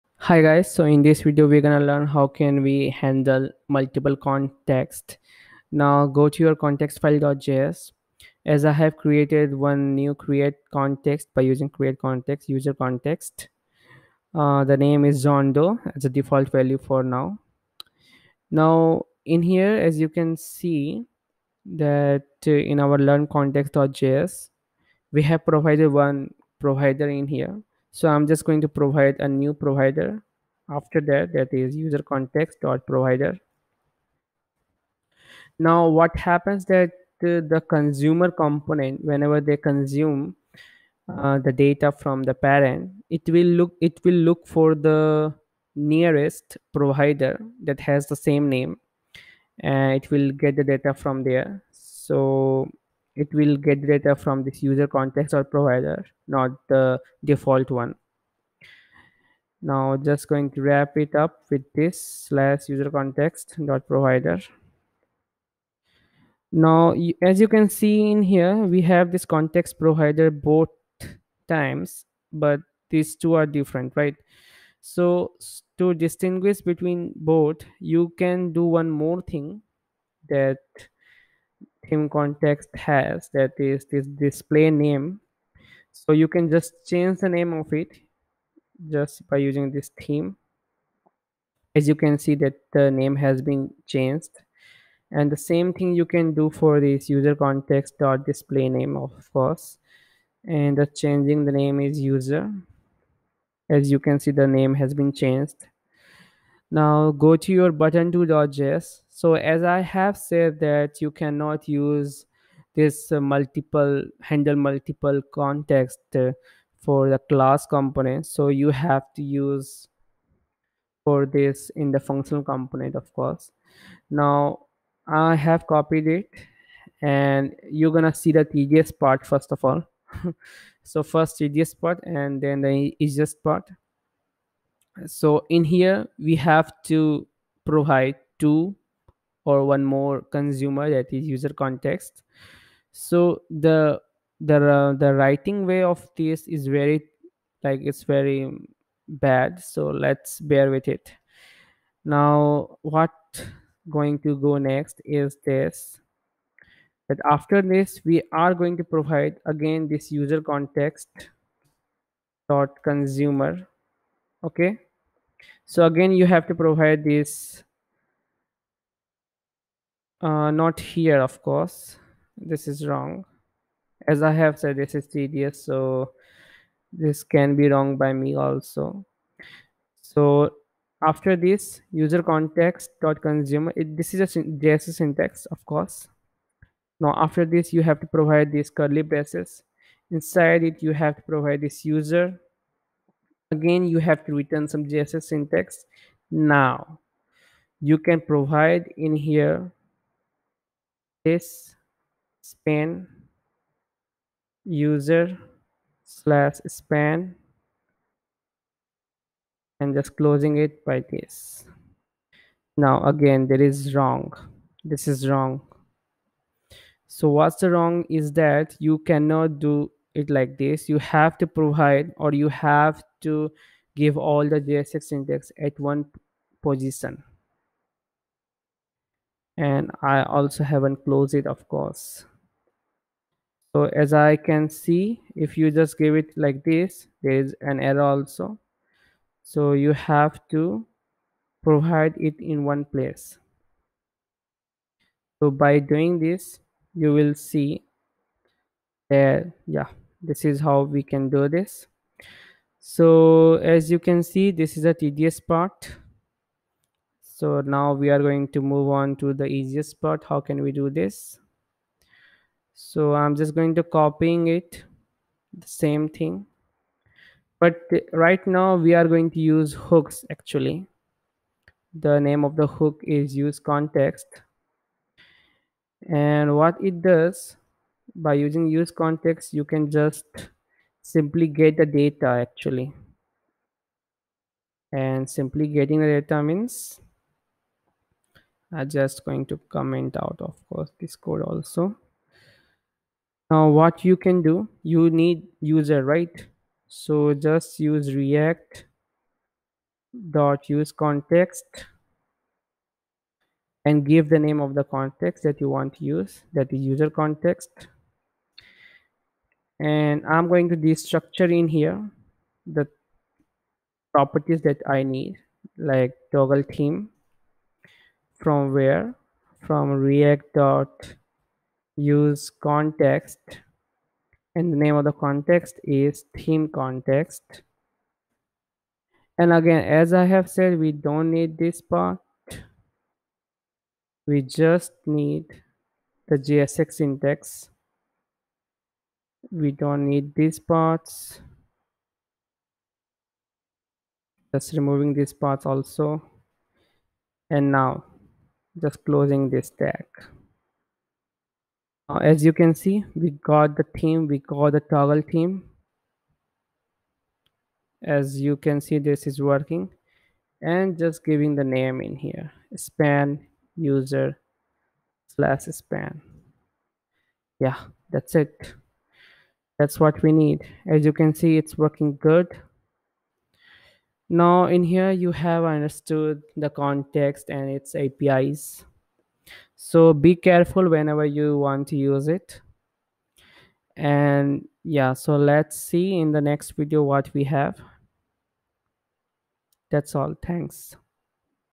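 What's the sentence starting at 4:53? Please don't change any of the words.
Now, what you can do, you need user, right?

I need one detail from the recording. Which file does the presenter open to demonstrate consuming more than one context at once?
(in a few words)
button2.js.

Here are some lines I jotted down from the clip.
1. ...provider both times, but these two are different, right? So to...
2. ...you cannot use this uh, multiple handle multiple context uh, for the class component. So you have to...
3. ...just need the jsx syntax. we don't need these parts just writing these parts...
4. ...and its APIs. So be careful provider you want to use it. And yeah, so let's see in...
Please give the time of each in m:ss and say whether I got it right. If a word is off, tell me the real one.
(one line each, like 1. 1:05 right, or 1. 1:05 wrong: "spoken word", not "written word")
1. 1:09 right
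2. 1:50 right
3. 5:34 wrong: "removing", not "writing"
4. 6:17 wrong: "whenever", not "provider".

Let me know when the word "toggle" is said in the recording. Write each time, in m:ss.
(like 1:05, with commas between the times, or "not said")
5:16, 5:54.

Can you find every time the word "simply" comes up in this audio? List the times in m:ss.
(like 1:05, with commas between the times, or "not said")
4:41, 4:45.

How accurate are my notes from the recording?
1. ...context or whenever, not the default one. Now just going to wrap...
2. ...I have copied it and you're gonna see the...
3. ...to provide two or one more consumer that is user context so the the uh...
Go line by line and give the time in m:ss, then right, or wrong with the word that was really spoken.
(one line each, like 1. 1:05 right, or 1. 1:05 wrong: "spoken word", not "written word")
1. 0:54 wrong: "provider", not "whenever"
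2. 2:05 right
3. 2:16 right.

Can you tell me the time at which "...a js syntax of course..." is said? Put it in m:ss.
3:04.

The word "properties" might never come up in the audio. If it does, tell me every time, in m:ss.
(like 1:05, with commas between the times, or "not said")
5:14.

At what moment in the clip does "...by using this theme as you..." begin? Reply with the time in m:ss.
1:29.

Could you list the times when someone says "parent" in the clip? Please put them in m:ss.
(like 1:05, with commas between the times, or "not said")
0:42.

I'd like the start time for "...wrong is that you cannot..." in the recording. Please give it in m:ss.
3:37.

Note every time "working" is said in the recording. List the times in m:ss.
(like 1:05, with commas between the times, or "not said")
5:59, 6:11.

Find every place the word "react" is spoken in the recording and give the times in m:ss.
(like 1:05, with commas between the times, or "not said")
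4:58, 5:19.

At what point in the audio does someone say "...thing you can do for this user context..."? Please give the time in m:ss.
1:35.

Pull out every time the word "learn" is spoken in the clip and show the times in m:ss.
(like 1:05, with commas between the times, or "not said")
0:01, 0:22.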